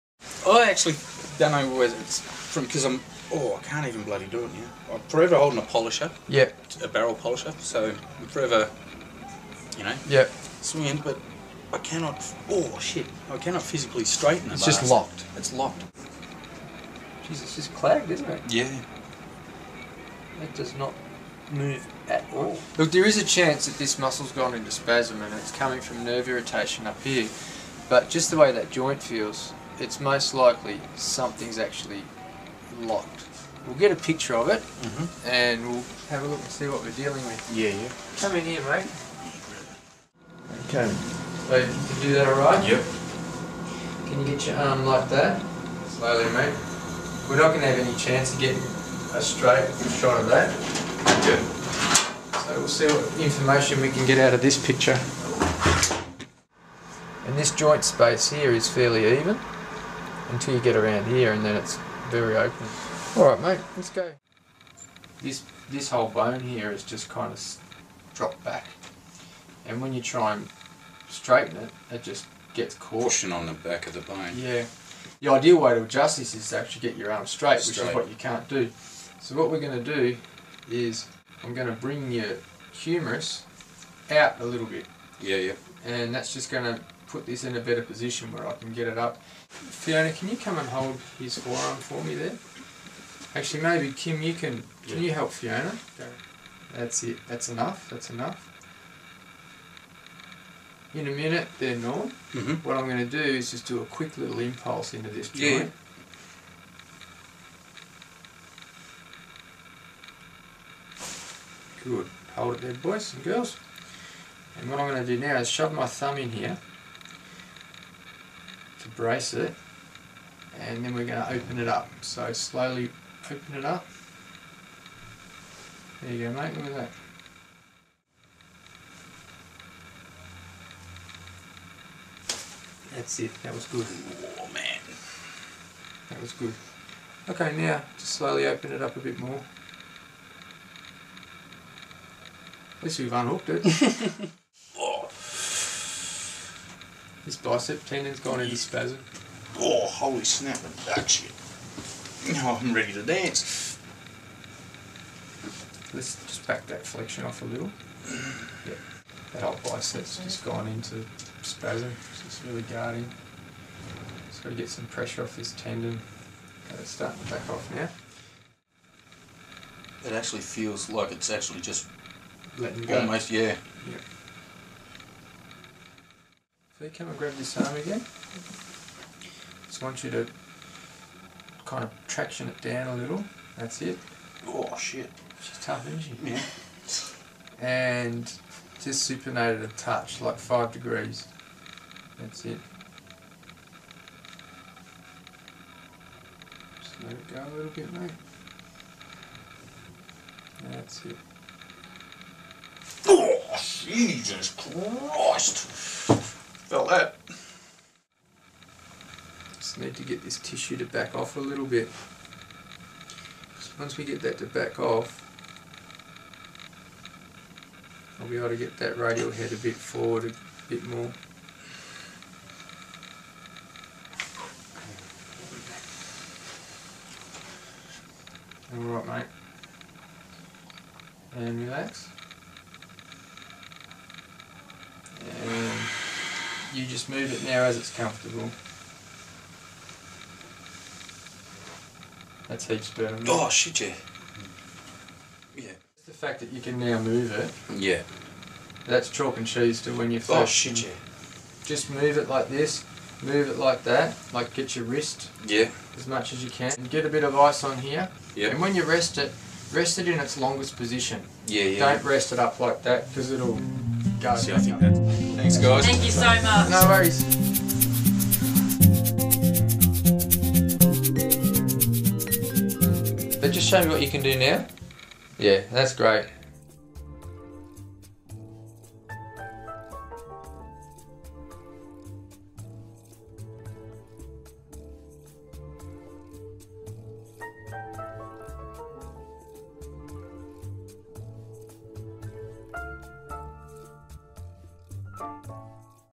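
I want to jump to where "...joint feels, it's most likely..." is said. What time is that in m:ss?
0:28.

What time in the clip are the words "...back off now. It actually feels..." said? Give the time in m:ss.
2:47.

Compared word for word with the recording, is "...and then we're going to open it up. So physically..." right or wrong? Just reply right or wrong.
wrong.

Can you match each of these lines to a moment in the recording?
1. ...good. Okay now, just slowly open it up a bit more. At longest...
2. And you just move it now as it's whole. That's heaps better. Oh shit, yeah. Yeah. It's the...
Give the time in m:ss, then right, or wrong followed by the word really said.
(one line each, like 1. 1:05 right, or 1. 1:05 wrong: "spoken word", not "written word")
1. 2:16 wrong: "least", not "longest"
2. 3:55 wrong: "comfortable", not "whole".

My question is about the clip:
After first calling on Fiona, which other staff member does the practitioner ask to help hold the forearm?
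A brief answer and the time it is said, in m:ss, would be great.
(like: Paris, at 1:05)
Kim, at 1:33.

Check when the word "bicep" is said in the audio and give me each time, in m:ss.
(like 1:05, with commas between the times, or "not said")
2:27, 2:39.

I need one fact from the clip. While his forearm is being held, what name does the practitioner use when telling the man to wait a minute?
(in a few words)
Norm.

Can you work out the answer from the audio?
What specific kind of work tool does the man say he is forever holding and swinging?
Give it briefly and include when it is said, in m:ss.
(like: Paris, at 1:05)
barrel polisher, at 0:06.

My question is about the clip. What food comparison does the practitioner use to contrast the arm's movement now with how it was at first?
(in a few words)
chalk and cheese.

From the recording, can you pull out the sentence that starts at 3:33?
So once we get that to back off, I'll be able to get that radial head a bit forward a bit more.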